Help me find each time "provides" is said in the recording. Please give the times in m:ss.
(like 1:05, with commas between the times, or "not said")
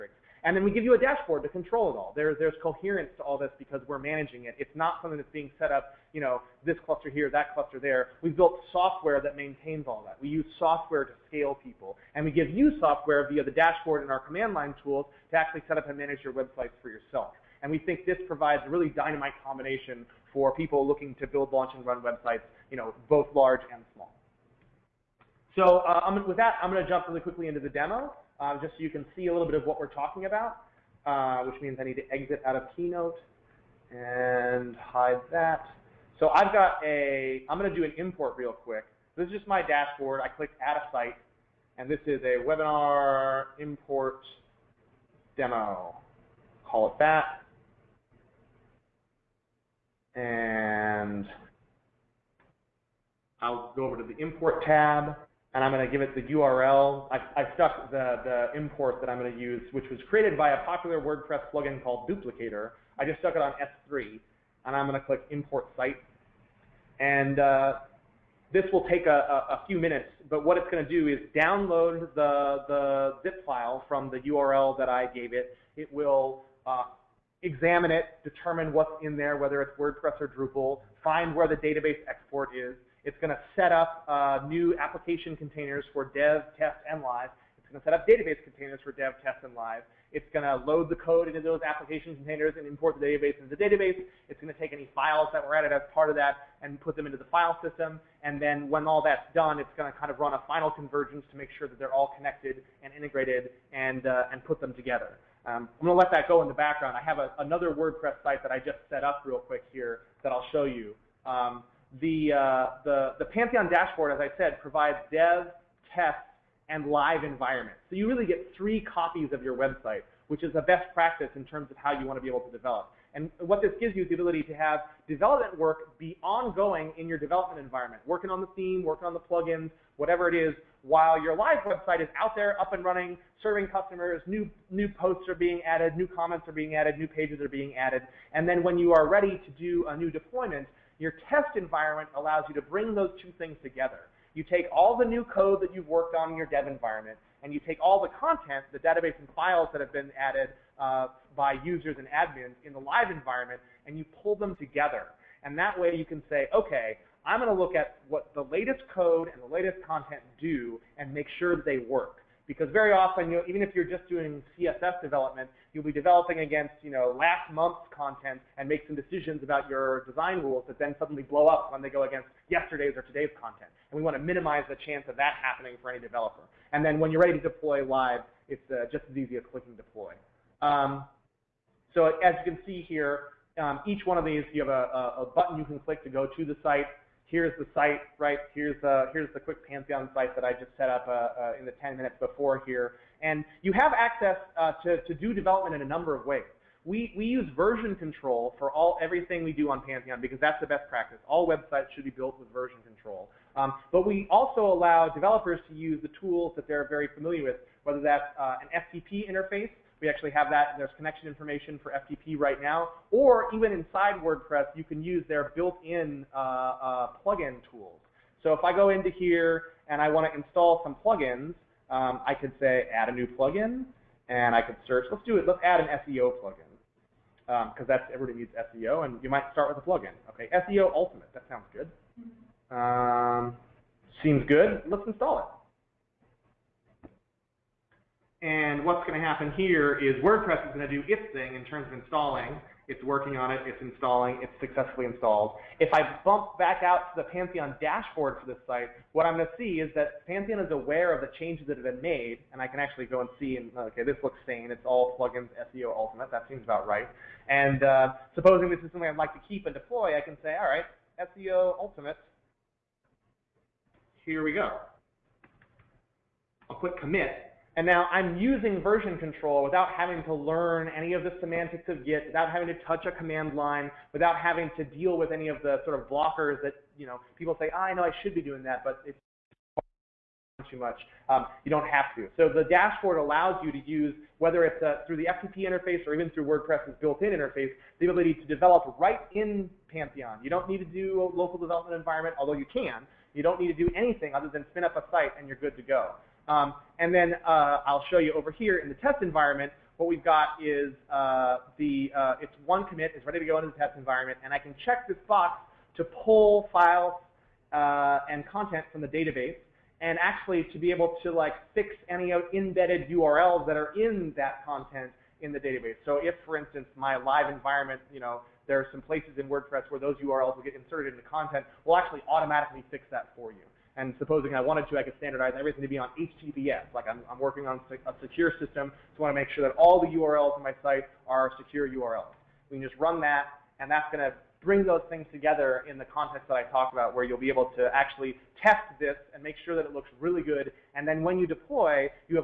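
0:18, 1:54.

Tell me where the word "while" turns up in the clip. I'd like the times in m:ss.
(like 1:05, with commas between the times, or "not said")
2:10.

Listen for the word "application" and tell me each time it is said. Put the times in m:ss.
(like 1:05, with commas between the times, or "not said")
1:24, 1:31.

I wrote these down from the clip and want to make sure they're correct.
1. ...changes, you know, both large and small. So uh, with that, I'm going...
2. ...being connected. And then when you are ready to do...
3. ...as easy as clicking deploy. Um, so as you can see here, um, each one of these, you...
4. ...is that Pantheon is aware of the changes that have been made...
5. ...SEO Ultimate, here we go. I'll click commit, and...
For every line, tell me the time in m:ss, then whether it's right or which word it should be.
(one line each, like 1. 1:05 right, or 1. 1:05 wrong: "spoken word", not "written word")
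1. 0:22 wrong: "websites", not "changes"
2. 2:17 wrong: "added", not "connected"
3. 2:59 right
4. 4:09 right
5. 4:21 right.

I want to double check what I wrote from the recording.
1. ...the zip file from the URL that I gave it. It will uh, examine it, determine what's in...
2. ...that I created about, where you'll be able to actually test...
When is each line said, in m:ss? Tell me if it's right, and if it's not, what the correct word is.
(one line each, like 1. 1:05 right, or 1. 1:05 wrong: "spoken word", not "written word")
1. 1:12 right
2. 5:36 wrong: "talked", not "created".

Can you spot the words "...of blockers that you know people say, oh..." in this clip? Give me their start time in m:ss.
4:35.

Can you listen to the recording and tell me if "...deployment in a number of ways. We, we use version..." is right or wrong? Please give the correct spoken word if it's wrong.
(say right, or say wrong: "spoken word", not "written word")
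wrong: "development", not "deployment".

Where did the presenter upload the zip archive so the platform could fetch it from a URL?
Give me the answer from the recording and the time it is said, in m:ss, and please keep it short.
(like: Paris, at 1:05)
S3, at 1:03.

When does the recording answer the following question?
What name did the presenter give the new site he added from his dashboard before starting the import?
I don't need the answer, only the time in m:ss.
0:42.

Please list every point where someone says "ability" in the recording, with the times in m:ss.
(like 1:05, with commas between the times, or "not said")
2:04, 4:48.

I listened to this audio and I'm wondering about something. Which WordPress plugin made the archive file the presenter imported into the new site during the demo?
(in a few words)
Duplicator.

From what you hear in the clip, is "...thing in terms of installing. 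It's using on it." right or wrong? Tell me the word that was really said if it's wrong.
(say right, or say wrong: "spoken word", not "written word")
wrong: "working", not "using".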